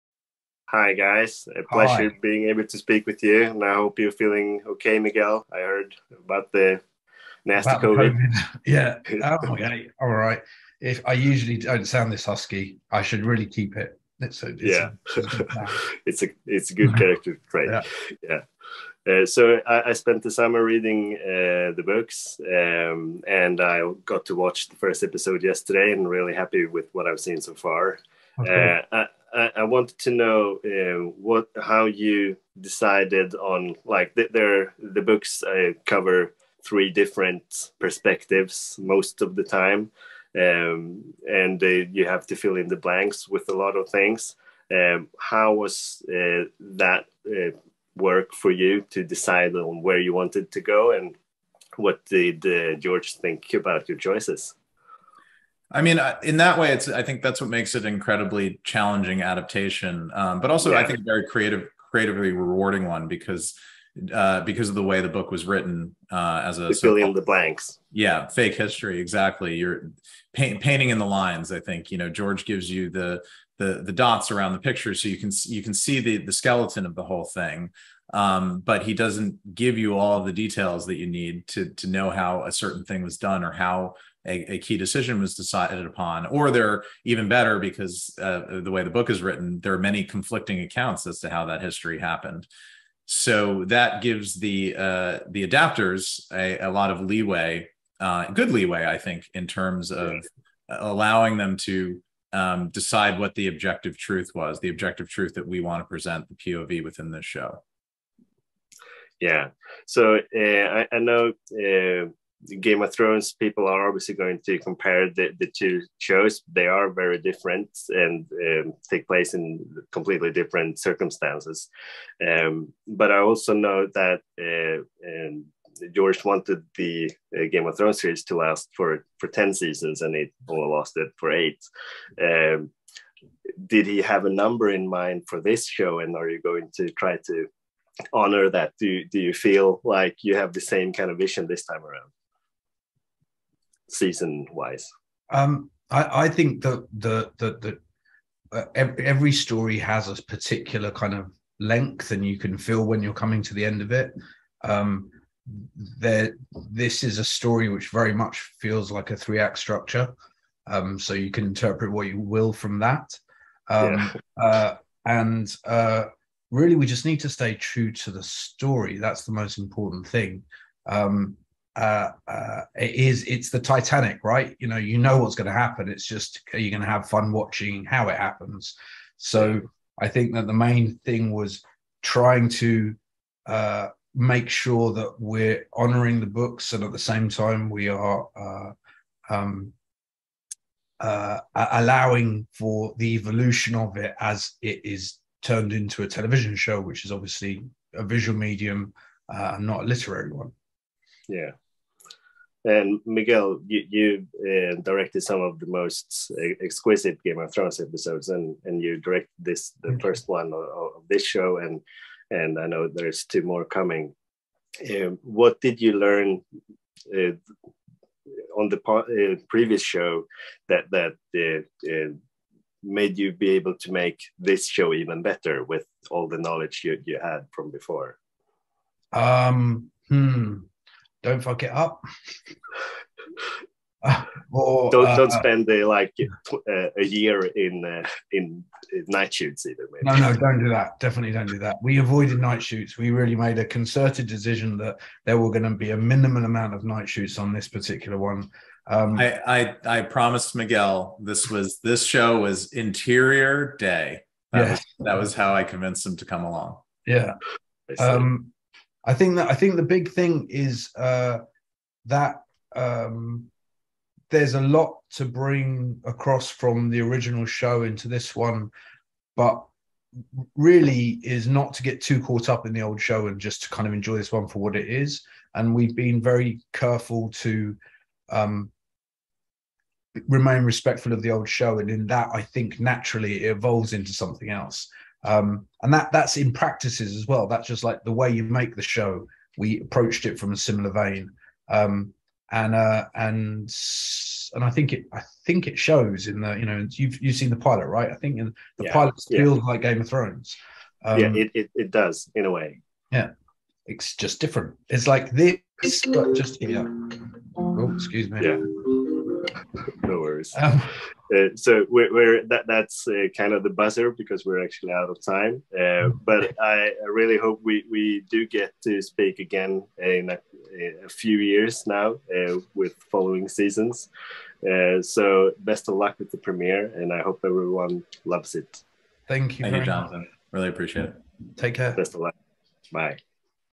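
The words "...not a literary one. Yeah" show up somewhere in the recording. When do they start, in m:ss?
3:19.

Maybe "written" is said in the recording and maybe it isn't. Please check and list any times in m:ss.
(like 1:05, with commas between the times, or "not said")
1:05, 1:29.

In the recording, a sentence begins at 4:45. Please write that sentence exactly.
Um, and that that's in practices as well.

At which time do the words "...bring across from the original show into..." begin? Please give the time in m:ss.
4:25.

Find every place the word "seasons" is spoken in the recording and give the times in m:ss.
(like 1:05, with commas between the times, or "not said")
2:09, 2:23, 5:23.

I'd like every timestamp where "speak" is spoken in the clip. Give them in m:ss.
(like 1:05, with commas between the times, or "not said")
0:02, 5:19.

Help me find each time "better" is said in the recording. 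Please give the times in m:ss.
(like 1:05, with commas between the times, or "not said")
1:27, 3:45.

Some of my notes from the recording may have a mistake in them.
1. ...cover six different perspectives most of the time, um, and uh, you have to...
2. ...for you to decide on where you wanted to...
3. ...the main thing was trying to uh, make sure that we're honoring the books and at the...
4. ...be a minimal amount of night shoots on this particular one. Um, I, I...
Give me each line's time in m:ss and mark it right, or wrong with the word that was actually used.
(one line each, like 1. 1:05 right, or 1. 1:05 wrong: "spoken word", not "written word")
1. 0:35 wrong: "three", not "six"
2. 0:48 right
3. 3:00 right
4. 4:05 right.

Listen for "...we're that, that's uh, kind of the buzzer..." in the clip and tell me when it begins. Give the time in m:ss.
5:12.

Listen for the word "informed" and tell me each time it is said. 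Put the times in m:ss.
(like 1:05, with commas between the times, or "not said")
not said.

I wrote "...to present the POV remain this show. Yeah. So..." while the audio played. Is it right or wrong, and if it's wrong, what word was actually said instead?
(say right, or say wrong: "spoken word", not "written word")
wrong: "within", not "remain".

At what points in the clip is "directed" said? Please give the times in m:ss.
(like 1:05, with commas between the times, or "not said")
3:24, 3:28.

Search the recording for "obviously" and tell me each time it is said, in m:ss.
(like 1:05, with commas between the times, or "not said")
1:53, 3:17.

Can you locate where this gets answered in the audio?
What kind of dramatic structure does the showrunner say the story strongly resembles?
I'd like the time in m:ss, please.
2:39.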